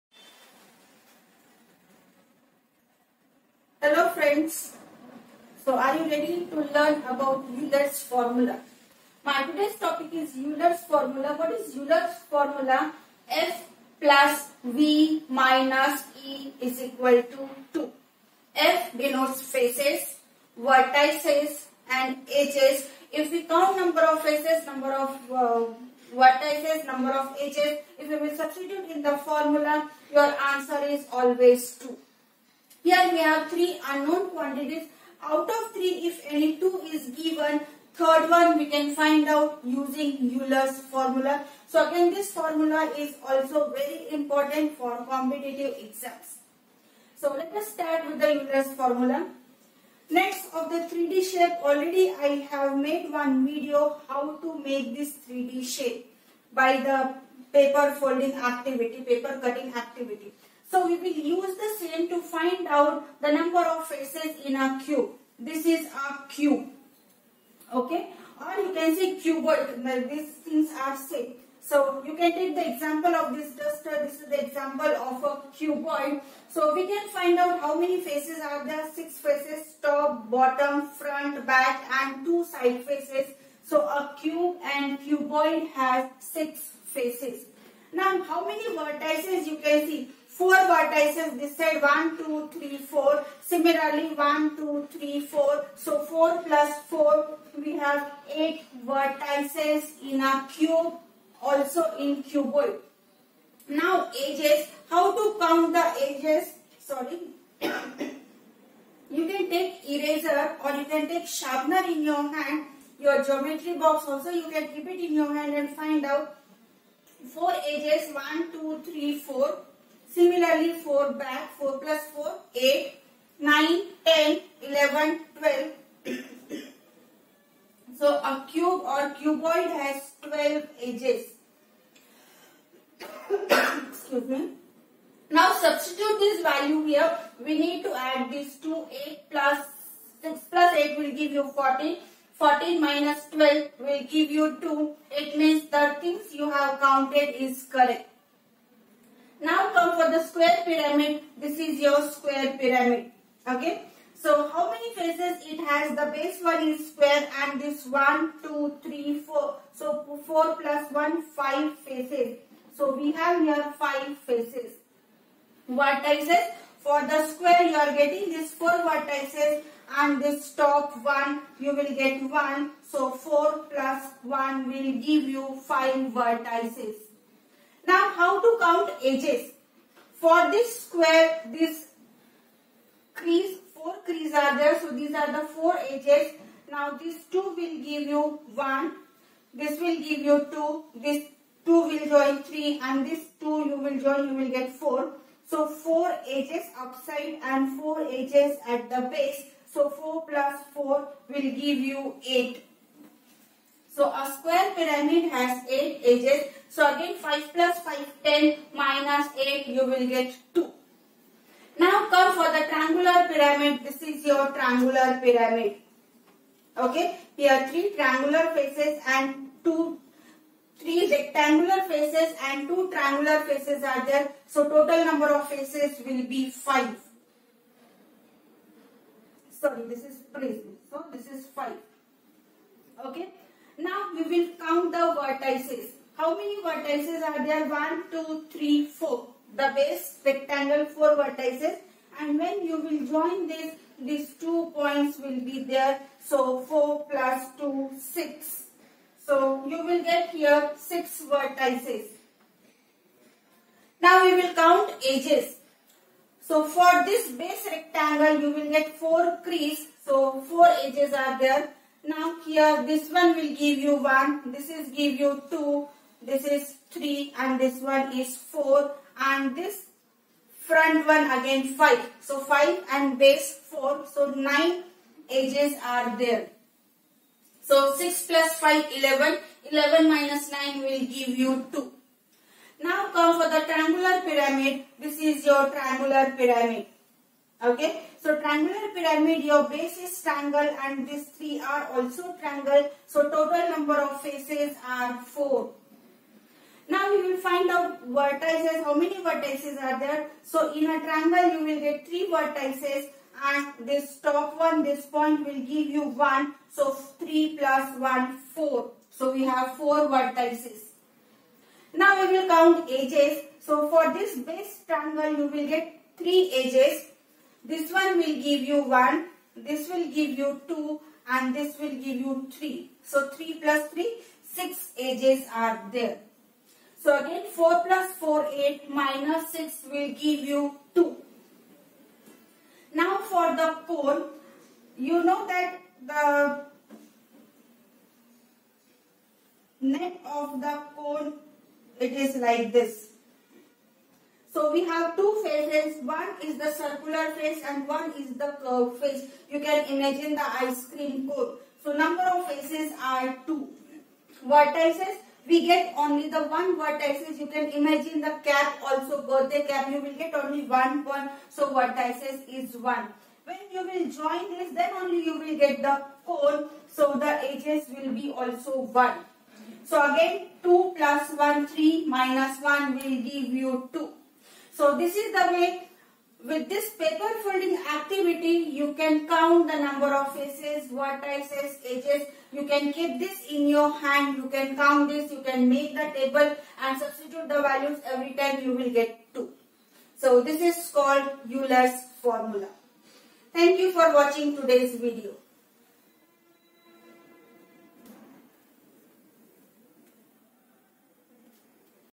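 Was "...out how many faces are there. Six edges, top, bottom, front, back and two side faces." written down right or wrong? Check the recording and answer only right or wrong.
wrong.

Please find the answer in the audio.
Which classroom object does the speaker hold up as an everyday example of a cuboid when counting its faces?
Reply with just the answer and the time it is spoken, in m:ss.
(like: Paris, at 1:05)
Duster, at 1:13.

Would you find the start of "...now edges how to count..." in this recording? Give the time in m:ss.
1:43.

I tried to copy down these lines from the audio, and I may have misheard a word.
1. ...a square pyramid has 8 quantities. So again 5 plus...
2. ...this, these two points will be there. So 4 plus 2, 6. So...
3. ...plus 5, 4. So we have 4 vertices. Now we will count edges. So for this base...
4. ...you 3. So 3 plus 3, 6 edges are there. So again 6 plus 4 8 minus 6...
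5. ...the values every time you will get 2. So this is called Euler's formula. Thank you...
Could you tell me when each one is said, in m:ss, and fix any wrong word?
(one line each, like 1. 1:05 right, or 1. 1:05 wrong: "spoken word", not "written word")
1. 3:24 wrong: "edges", not "quantities"
2. 4:03 right
3. 5:07 wrong: "1", not "5"
4. 5:22 wrong: "4", not "6"
5. 6:27 right.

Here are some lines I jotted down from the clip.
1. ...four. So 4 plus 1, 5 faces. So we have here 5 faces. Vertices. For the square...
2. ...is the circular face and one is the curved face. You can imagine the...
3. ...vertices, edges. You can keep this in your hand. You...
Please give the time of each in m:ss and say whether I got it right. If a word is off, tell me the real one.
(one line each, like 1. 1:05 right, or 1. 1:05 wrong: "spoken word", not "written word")
1. 2:39 right
2. 5:46 right
3. 6:20 right.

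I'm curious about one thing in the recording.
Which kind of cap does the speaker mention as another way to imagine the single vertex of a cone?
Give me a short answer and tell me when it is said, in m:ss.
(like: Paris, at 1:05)
Goethe cap, at 5:59.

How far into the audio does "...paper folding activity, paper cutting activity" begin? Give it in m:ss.
0:57.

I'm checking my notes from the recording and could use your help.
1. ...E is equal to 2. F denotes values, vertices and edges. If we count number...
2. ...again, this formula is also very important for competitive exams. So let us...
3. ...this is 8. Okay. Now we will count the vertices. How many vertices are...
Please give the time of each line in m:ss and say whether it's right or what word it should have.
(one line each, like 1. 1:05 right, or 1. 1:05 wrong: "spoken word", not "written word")
1. 0:16 wrong: "faces", not "values"
2. 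0:41 right
3. 3:51 wrong: "5", not "8".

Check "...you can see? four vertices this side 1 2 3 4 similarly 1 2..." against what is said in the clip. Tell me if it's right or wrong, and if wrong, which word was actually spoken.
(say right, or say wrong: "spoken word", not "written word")
right.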